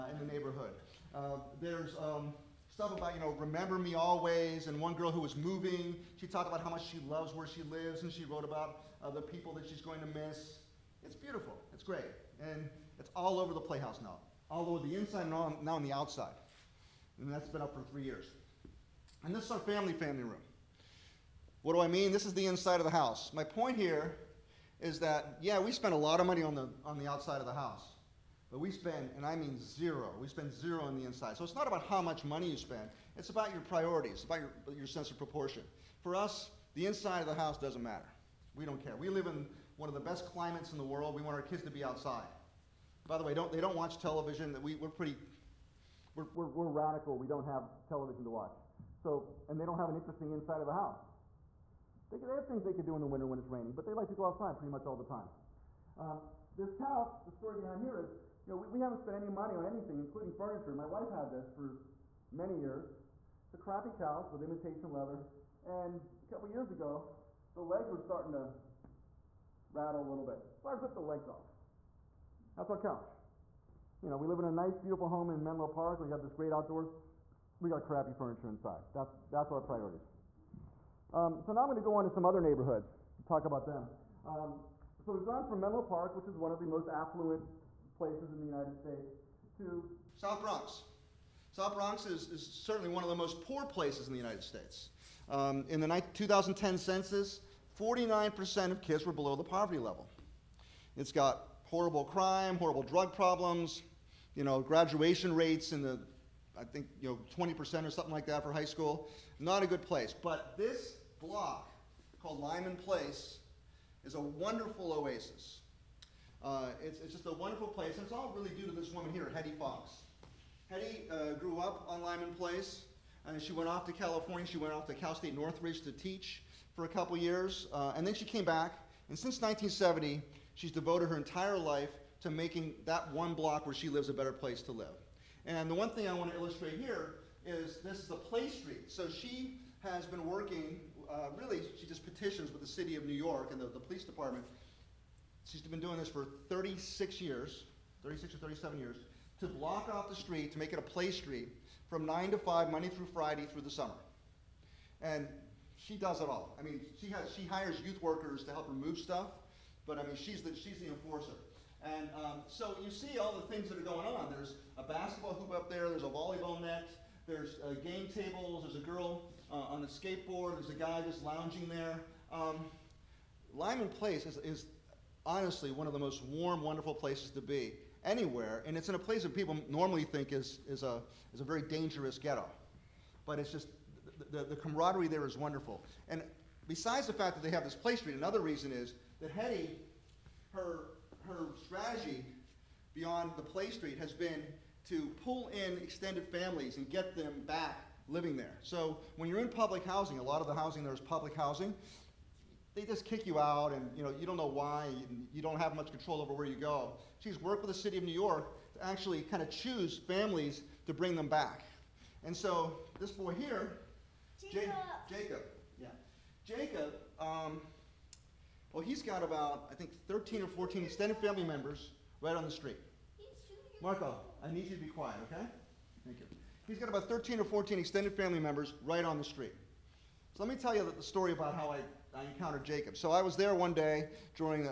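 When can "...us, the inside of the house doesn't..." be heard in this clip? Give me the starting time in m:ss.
0:36.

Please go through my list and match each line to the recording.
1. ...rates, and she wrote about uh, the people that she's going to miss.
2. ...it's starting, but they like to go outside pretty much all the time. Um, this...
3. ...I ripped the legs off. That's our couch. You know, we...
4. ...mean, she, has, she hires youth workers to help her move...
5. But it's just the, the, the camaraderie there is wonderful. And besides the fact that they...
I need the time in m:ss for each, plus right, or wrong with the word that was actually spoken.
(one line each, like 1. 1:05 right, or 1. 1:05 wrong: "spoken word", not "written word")
1. 0:07 wrong: "lives", not "rates"
2. 0:53 wrong: "raining", not "starting"
3. 1:10 right
4. 2:36 right
5. 3:03 right.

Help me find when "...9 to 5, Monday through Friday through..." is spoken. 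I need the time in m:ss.
2:32.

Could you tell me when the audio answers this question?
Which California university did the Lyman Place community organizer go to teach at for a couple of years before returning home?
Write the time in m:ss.
2:04.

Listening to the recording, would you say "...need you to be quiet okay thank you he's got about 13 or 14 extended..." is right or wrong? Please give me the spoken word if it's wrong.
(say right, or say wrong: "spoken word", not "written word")
right.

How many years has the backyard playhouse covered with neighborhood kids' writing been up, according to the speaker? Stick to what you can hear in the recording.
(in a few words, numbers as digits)
3.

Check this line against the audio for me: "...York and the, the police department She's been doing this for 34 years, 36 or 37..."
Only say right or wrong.
wrong.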